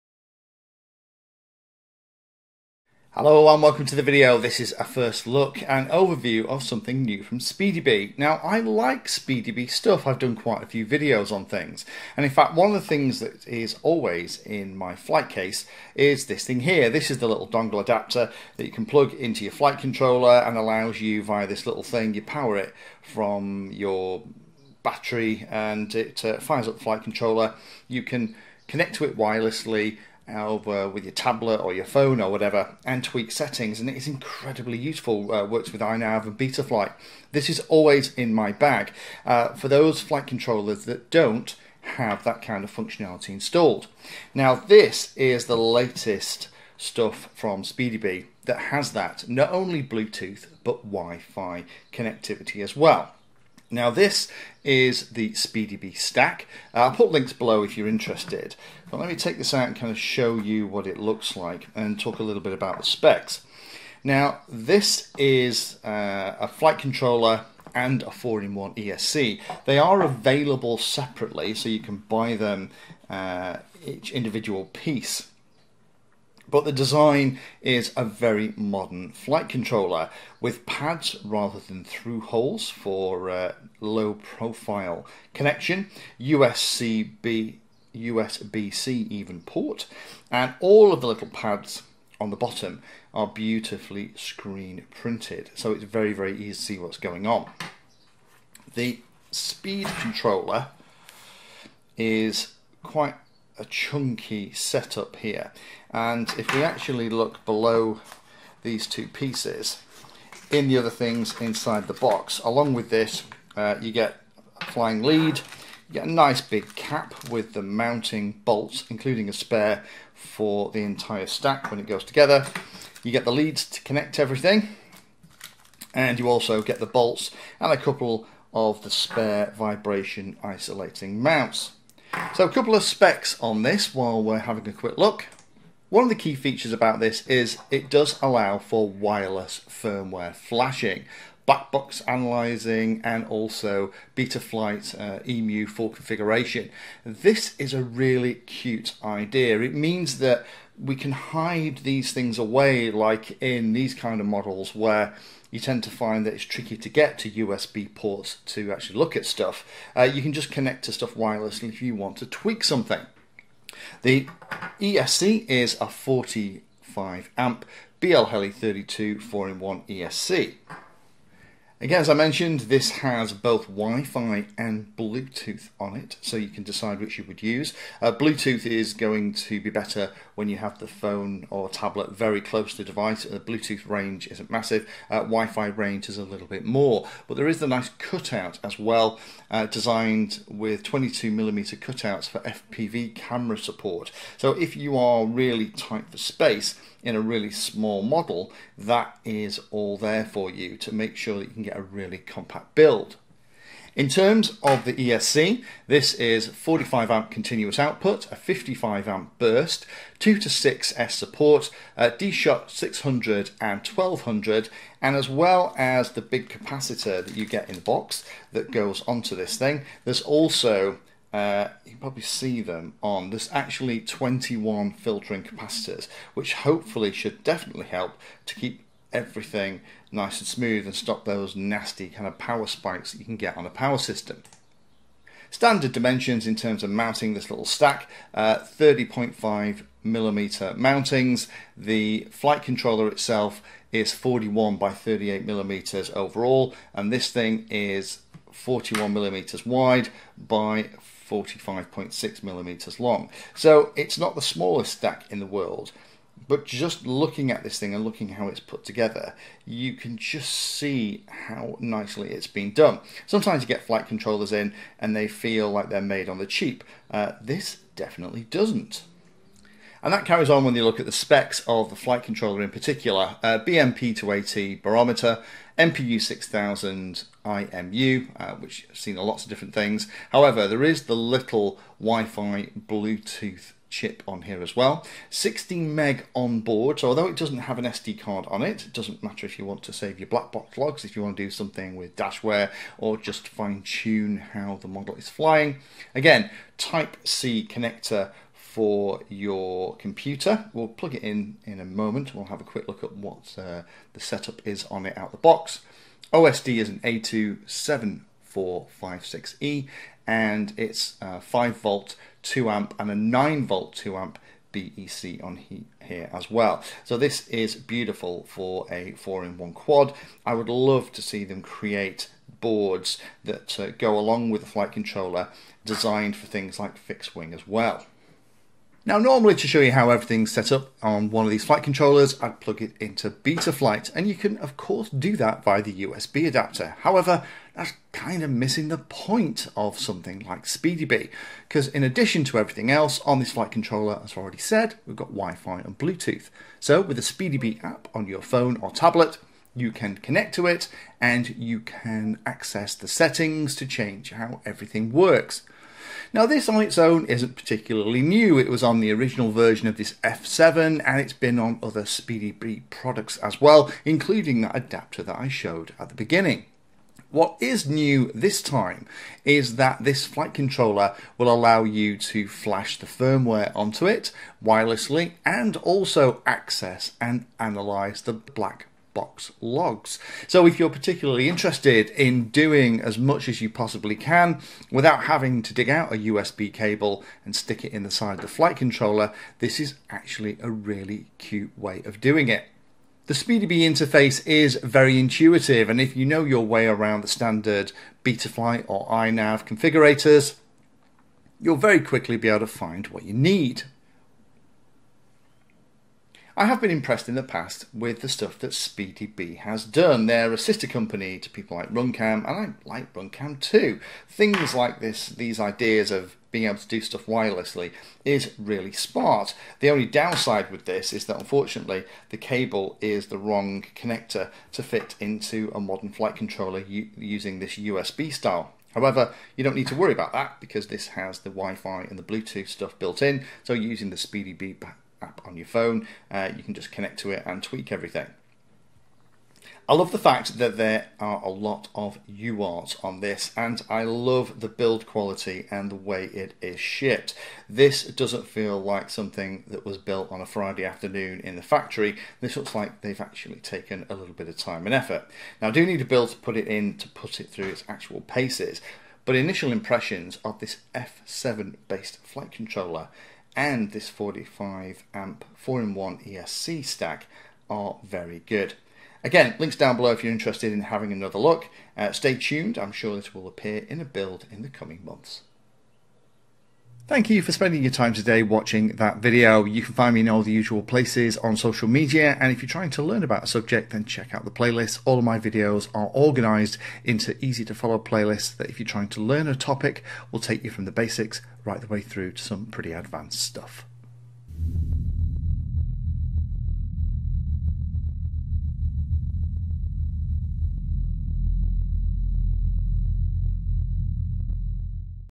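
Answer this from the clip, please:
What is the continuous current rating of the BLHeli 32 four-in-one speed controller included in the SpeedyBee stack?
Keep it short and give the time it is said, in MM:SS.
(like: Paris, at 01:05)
45 amp, at 02:45.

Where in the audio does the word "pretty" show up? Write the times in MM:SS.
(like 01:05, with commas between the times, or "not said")
08:12.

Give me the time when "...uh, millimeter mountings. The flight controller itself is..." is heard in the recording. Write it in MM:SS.
03:59.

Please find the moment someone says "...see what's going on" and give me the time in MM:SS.
01:36.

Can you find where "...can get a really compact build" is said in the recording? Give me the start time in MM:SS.
03:21.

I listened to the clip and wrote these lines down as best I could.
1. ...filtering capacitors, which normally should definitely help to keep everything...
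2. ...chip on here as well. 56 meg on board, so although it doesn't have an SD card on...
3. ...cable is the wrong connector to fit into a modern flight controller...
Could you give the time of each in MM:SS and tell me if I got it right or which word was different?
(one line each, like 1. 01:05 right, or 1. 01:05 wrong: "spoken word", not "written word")
1. 03:44 wrong: "hopefully", not "normally"
2. 04:43 wrong: "16", not "56"
3. 07:02 right.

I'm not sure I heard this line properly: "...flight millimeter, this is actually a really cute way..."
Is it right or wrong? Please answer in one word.
wrong.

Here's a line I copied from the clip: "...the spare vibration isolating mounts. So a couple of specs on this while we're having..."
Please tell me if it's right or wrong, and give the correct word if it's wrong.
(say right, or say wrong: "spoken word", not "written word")
right.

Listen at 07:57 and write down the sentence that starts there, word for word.
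Thank you for spending your time today watching that video.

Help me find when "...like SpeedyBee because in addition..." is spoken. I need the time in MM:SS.
05:40.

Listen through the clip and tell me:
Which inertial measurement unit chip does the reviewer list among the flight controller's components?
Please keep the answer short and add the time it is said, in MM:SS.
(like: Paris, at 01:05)
MPU 6000, at 04:35.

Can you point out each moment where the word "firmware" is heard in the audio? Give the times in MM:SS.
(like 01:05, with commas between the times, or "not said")
02:19, 06:13.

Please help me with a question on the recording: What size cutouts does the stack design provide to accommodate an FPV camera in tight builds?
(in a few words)
22mm.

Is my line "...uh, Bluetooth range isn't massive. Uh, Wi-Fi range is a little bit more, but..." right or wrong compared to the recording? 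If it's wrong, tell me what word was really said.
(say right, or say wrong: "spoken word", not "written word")
right.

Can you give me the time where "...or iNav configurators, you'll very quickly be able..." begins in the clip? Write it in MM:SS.
06:38.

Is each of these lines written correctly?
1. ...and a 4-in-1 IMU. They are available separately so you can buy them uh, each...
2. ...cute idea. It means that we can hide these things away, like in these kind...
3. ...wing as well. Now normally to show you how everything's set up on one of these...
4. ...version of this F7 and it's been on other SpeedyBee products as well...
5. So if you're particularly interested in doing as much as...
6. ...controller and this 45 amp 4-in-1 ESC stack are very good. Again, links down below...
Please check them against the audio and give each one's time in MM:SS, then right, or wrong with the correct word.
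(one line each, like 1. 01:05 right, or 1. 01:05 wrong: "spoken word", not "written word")
1. 01:07 wrong: "ESC", not "IMU"
2. 02:28 right
3. 05:27 right
4. 05:59 right
5. 06:20 right
6. 07:42 right.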